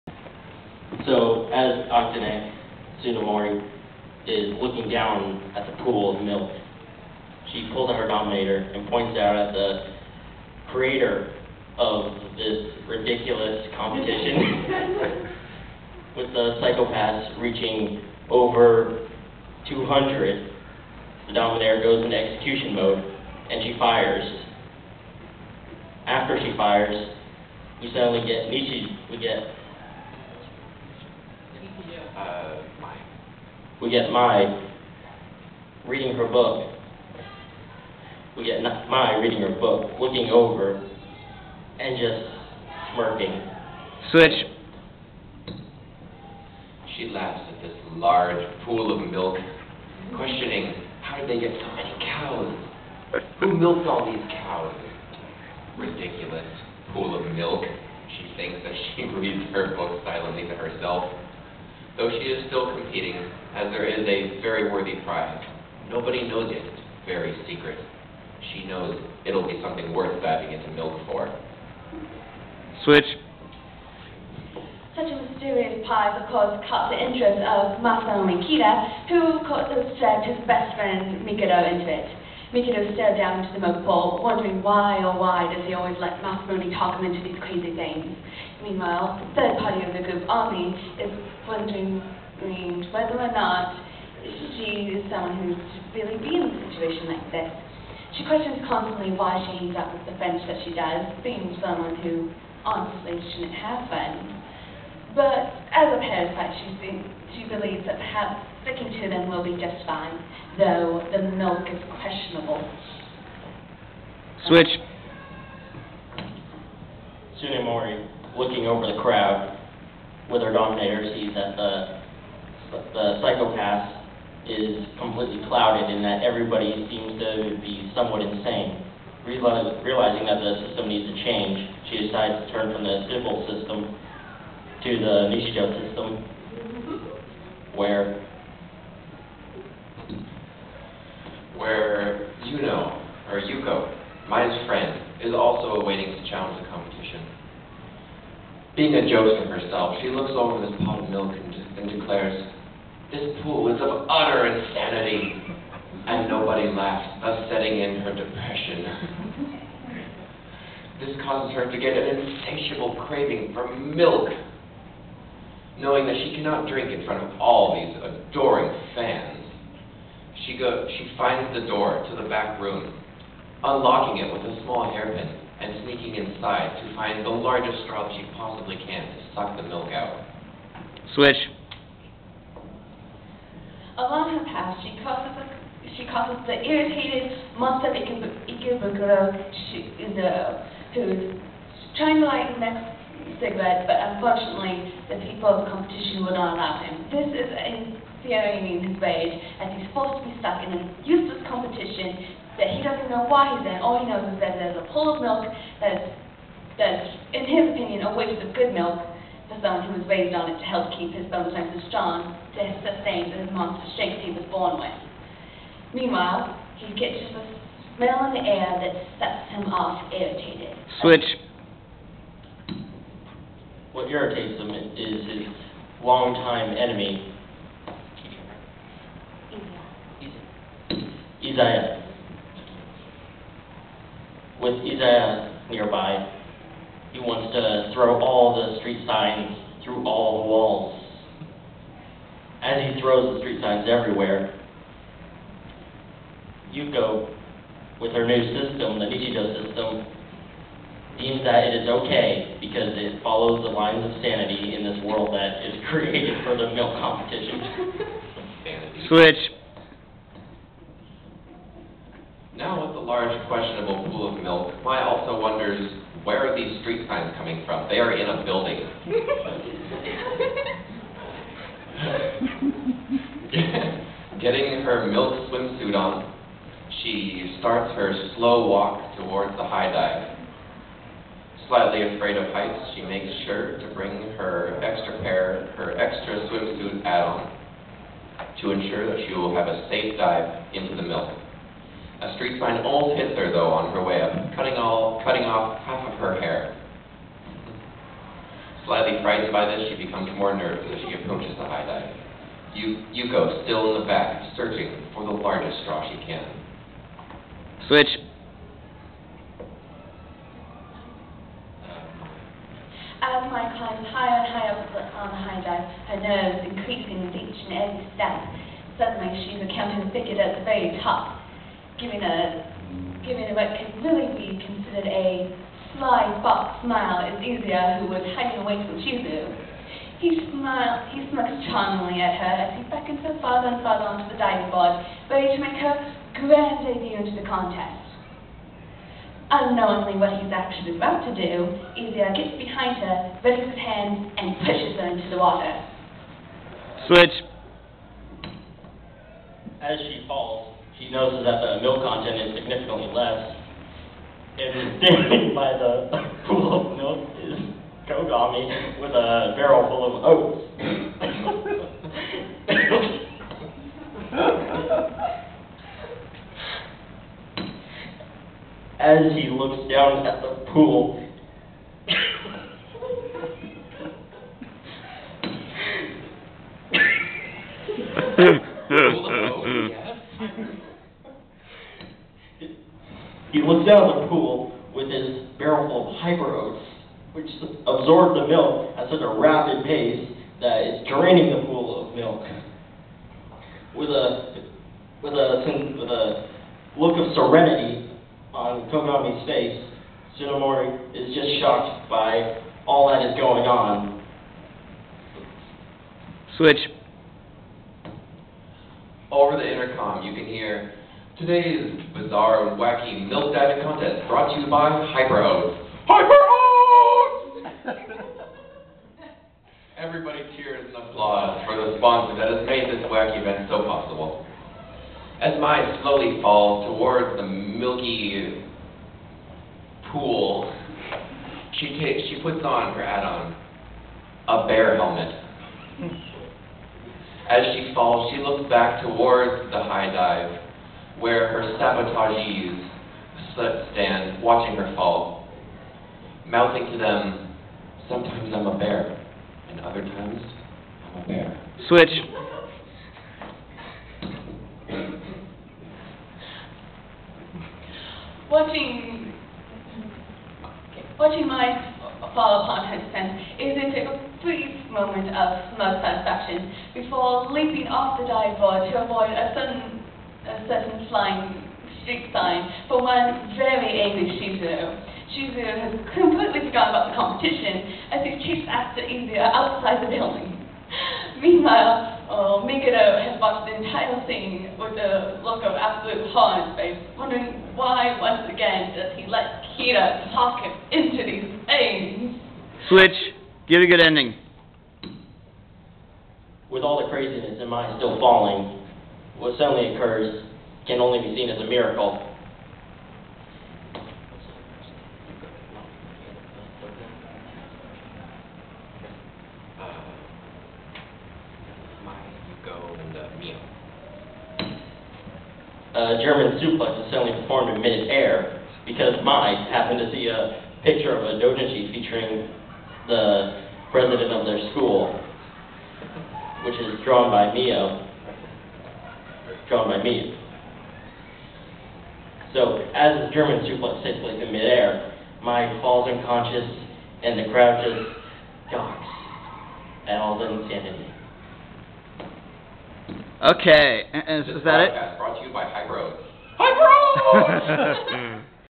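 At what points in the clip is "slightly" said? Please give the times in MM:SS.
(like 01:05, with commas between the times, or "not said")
04:41, 04:58.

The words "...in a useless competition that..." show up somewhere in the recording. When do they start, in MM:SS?
03:20.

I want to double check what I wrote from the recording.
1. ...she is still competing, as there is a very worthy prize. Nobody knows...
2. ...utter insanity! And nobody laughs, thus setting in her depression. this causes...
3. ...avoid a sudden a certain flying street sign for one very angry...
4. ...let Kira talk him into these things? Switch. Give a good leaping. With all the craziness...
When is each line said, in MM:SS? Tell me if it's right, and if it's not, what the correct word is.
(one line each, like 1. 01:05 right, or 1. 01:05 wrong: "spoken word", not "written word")
1. 01:02 right
2. 02:34 right
3. 07:49 right
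4. 08:09 wrong: "ending", not "leaping".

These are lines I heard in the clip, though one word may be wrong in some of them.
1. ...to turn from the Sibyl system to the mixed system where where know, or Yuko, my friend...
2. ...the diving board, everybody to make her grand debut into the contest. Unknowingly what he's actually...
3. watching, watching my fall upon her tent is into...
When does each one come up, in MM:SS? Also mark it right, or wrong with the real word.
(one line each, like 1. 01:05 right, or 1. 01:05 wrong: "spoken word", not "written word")
1. 02:12 right
2. 05:34 wrong: "ready", not "everybody"
3. 07:38 right.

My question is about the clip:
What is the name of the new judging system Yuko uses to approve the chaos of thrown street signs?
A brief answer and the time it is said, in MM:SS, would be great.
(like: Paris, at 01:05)
Nichido system, at 04:09.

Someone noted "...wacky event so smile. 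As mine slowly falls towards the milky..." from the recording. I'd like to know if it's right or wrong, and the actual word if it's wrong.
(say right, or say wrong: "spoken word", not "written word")
wrong: "possible", not "smile".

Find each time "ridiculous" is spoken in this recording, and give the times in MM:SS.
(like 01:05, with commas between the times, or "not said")
00:12, 00:55.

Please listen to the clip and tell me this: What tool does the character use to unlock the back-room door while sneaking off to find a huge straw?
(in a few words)
a small hairpin.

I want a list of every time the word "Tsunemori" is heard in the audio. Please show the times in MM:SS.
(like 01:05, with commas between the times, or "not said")
00:03, 01:57.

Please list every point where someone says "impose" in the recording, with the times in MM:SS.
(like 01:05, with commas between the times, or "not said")
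not said.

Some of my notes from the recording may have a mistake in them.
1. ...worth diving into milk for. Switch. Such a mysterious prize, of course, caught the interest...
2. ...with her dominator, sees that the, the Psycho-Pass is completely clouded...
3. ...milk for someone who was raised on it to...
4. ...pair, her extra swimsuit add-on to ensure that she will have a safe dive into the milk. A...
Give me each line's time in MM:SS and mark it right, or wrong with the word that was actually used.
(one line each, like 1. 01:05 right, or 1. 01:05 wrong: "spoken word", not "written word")
1. 01:09 right
2. 02:00 right
3. 03:28 right
4. 04:45 right.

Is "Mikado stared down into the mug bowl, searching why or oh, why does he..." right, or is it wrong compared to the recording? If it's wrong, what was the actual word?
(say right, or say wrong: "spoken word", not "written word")
wrong: "wondering", not "searching".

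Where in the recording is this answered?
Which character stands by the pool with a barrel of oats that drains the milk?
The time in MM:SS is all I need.
05:58.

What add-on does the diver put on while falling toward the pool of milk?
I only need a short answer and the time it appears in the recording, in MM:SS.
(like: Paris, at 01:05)
a bear helmet, at 07:14.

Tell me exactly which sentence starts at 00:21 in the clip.
The Dominator goes into execution mode and she fires.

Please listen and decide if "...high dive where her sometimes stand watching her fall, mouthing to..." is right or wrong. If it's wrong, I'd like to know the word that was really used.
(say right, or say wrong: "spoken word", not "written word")
wrong: "sabotagees", not "sometimes".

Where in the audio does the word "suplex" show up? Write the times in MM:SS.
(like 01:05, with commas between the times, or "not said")
08:36, 08:53.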